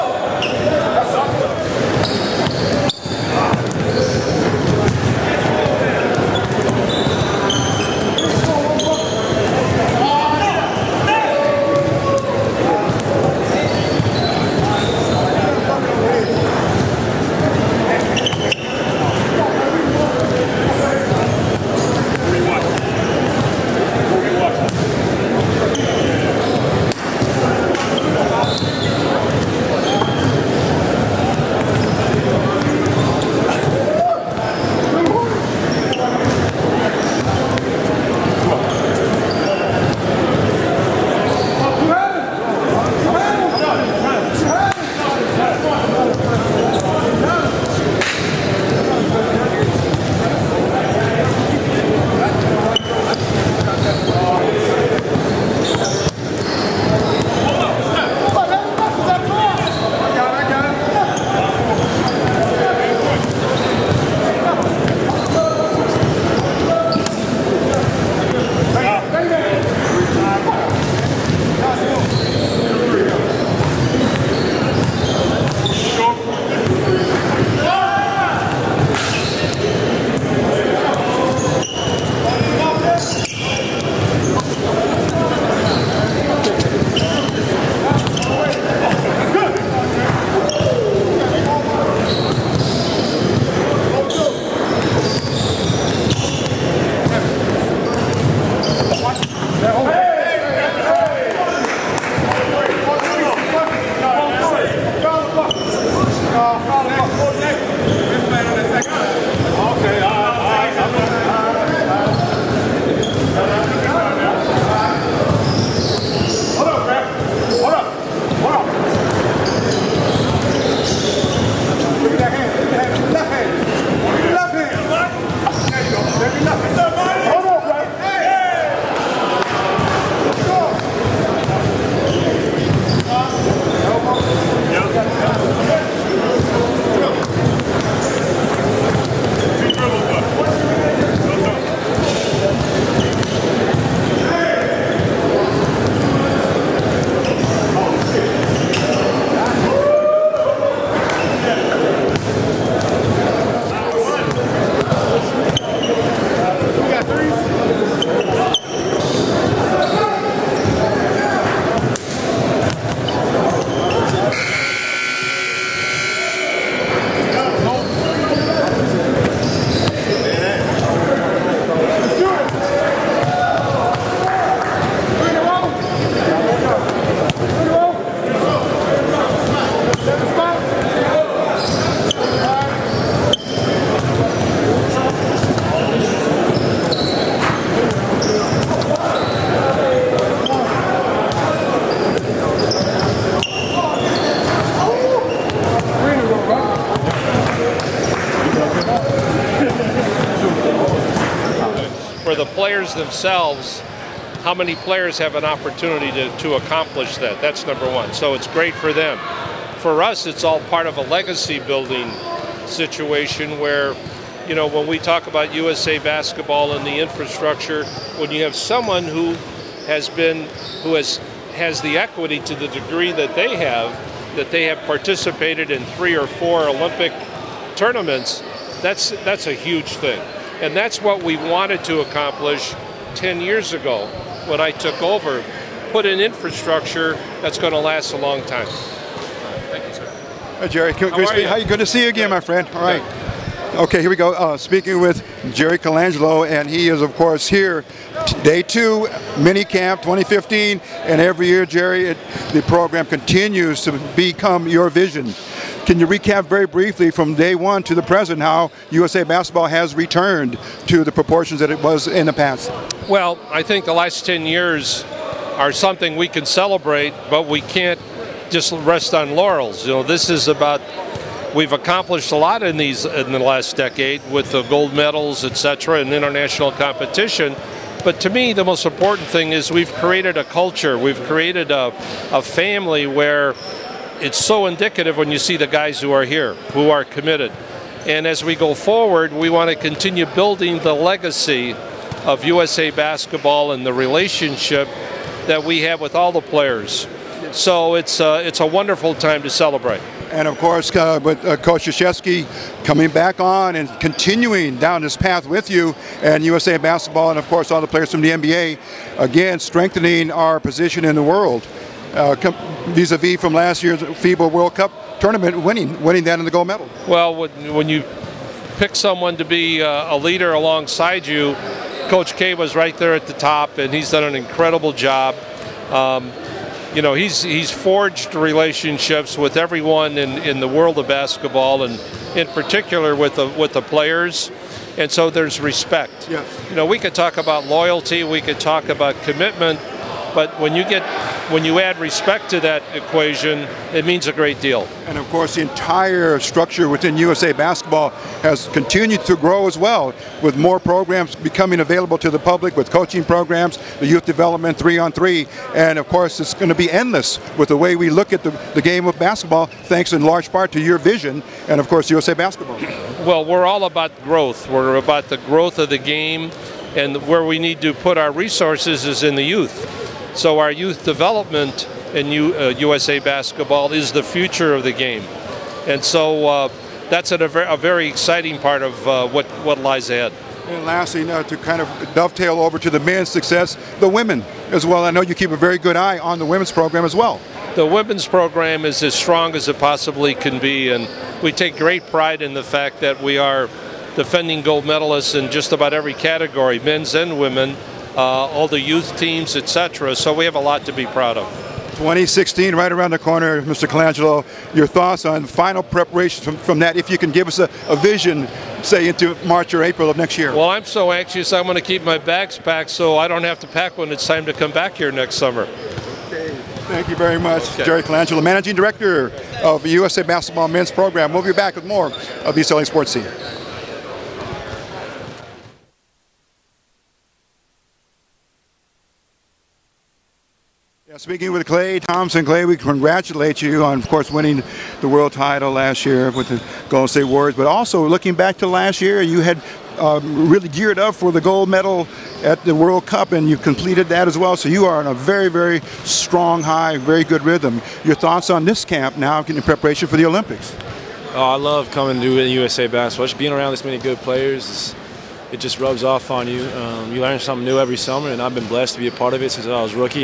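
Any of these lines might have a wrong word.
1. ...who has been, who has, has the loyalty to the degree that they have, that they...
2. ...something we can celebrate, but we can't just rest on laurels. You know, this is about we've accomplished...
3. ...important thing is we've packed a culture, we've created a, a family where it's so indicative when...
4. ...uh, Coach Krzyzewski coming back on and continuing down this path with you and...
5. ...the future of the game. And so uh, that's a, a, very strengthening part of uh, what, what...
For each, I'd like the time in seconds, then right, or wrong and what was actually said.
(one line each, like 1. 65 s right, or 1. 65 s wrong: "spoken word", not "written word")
1. 219 s wrong: "equity", not "loyalty"
2. 265 s right
3. 278 s wrong: "created", not "packed"
4. 301 s right
5. 374 s wrong: "exciting", not "strengthening".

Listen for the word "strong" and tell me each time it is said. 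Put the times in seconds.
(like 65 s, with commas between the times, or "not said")
389 s, 446 s.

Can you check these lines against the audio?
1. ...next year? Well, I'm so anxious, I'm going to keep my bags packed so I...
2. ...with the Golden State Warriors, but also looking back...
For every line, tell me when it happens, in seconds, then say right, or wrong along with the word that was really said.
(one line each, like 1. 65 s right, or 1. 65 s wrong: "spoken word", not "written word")
1. 410 s right
2. 436 s right.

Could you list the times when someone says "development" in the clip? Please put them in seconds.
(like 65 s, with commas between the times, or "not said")
354 s, 371 s.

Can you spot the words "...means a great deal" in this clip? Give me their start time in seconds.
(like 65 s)
344 s.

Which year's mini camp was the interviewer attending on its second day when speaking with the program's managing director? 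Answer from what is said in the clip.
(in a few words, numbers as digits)
2015.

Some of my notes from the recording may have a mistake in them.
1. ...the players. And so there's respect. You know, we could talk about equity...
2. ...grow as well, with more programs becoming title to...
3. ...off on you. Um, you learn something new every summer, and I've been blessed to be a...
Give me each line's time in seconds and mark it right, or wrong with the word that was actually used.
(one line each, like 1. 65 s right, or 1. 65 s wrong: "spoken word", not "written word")
1. 333 s wrong: "loyalty", not "equity"
2. 349 s wrong: "available", not "title"
3. 456 s right.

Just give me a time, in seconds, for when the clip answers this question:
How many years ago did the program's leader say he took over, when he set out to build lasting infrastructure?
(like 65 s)
233 s.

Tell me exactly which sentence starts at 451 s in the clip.
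Oh, I love coming to USA basketball.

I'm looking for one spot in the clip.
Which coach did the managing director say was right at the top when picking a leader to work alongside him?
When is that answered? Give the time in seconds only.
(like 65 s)
322 s.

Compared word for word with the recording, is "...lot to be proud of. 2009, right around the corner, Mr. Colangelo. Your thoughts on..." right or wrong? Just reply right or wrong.
wrong.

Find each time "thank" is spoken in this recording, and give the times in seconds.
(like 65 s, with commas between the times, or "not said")
238 s, 359 s, 416 s.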